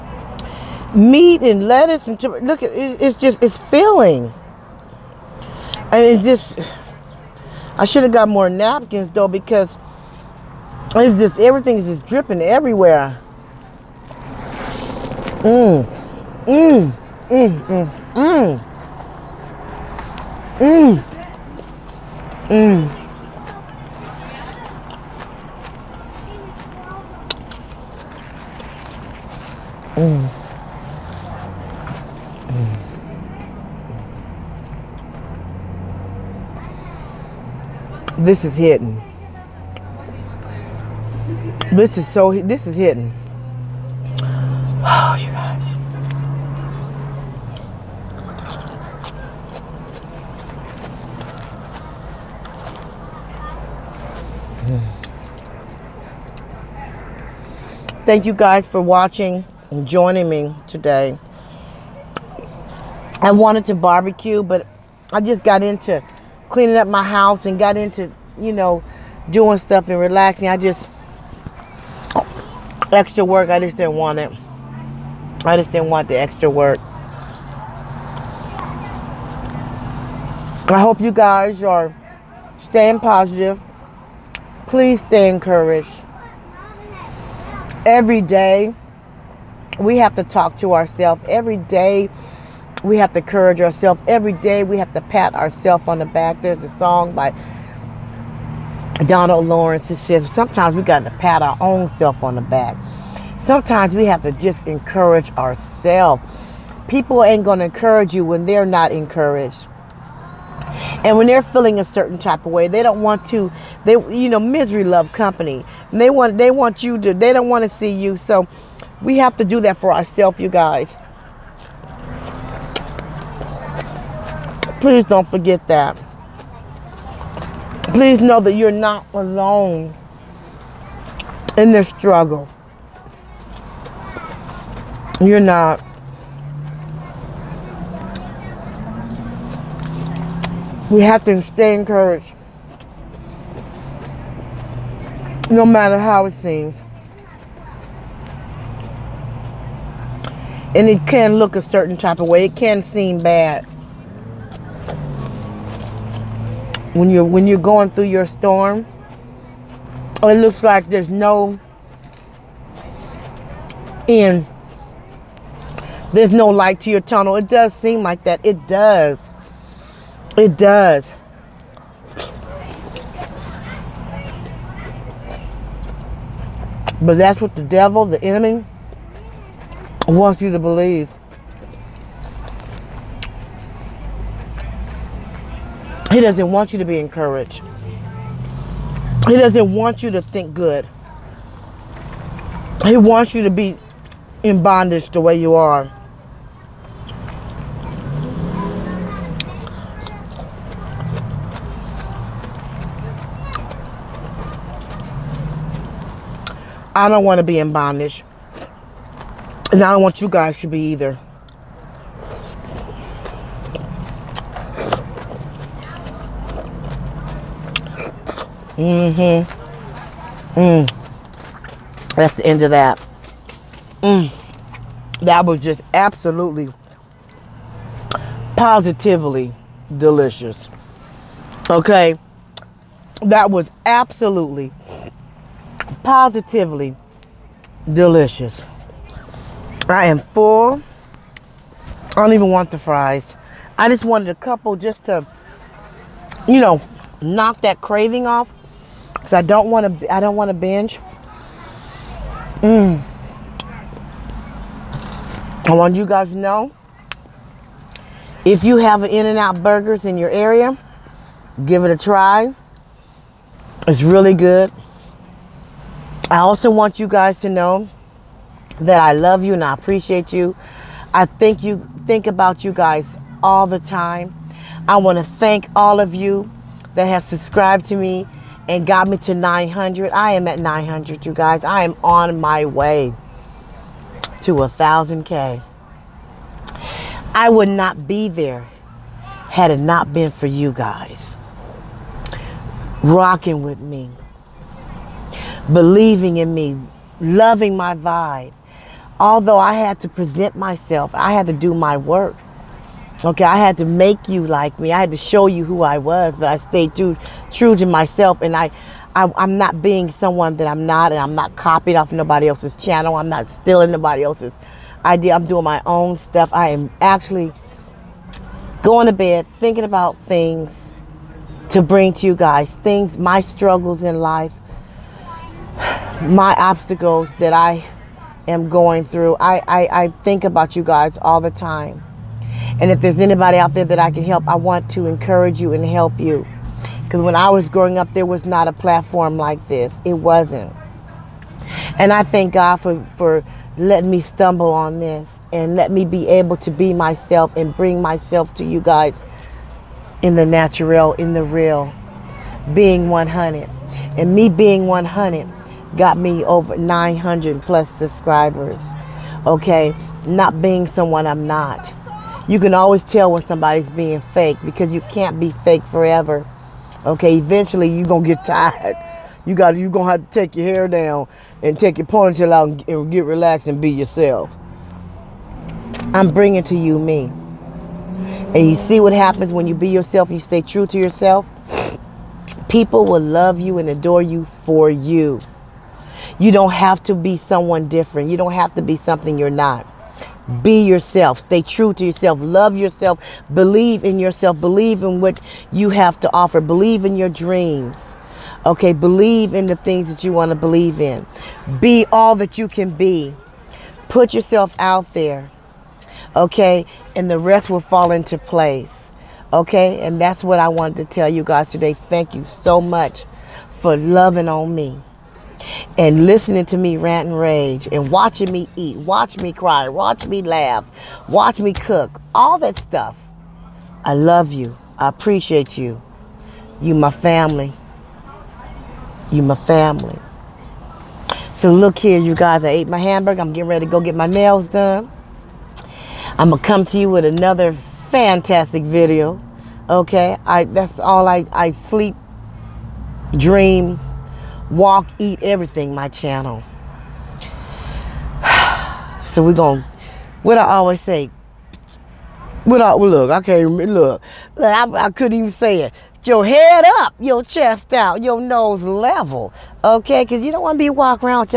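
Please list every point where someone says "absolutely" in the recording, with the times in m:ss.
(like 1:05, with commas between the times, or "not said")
3:45, 3:53.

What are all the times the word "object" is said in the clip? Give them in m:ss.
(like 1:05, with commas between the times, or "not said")
not said.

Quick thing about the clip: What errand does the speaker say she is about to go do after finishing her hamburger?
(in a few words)
get my nails done.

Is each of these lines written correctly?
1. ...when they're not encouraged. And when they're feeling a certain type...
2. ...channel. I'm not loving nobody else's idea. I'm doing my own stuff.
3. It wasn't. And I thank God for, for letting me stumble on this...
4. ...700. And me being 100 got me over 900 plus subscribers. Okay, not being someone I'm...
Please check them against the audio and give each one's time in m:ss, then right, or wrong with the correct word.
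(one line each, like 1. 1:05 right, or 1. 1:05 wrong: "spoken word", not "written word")
1. 1:48 right
2. 5:12 wrong: "stealing", not "loving"
3. 5:40 right
4. 5:53 wrong: "100", not "700".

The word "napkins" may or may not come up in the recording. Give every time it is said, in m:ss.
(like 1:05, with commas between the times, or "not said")
0:08.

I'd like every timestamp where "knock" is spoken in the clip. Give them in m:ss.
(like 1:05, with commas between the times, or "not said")
4:07.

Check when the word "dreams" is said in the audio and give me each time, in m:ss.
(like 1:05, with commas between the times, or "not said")
6:37, 7:23.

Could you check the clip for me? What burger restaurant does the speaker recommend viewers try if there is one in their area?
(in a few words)
In-N-Out Burgers.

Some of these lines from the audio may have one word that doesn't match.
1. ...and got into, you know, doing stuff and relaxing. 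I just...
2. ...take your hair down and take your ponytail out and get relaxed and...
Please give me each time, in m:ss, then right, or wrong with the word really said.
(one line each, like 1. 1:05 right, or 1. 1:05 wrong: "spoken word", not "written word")
1. 1:07 right
2. 6:10 right.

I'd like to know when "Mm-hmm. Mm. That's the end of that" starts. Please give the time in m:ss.
3:38.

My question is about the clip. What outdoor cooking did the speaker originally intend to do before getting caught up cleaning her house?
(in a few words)
barbecue.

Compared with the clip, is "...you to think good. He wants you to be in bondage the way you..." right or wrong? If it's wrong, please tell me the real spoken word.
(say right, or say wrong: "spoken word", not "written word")
right.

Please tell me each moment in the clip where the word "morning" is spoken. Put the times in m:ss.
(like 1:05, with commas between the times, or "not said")
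not said.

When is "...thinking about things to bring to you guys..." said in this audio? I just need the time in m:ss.
5:19.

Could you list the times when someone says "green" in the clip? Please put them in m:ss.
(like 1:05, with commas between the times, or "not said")
not said.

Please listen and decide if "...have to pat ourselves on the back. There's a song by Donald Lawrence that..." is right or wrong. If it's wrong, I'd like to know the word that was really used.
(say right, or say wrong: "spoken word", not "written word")
right.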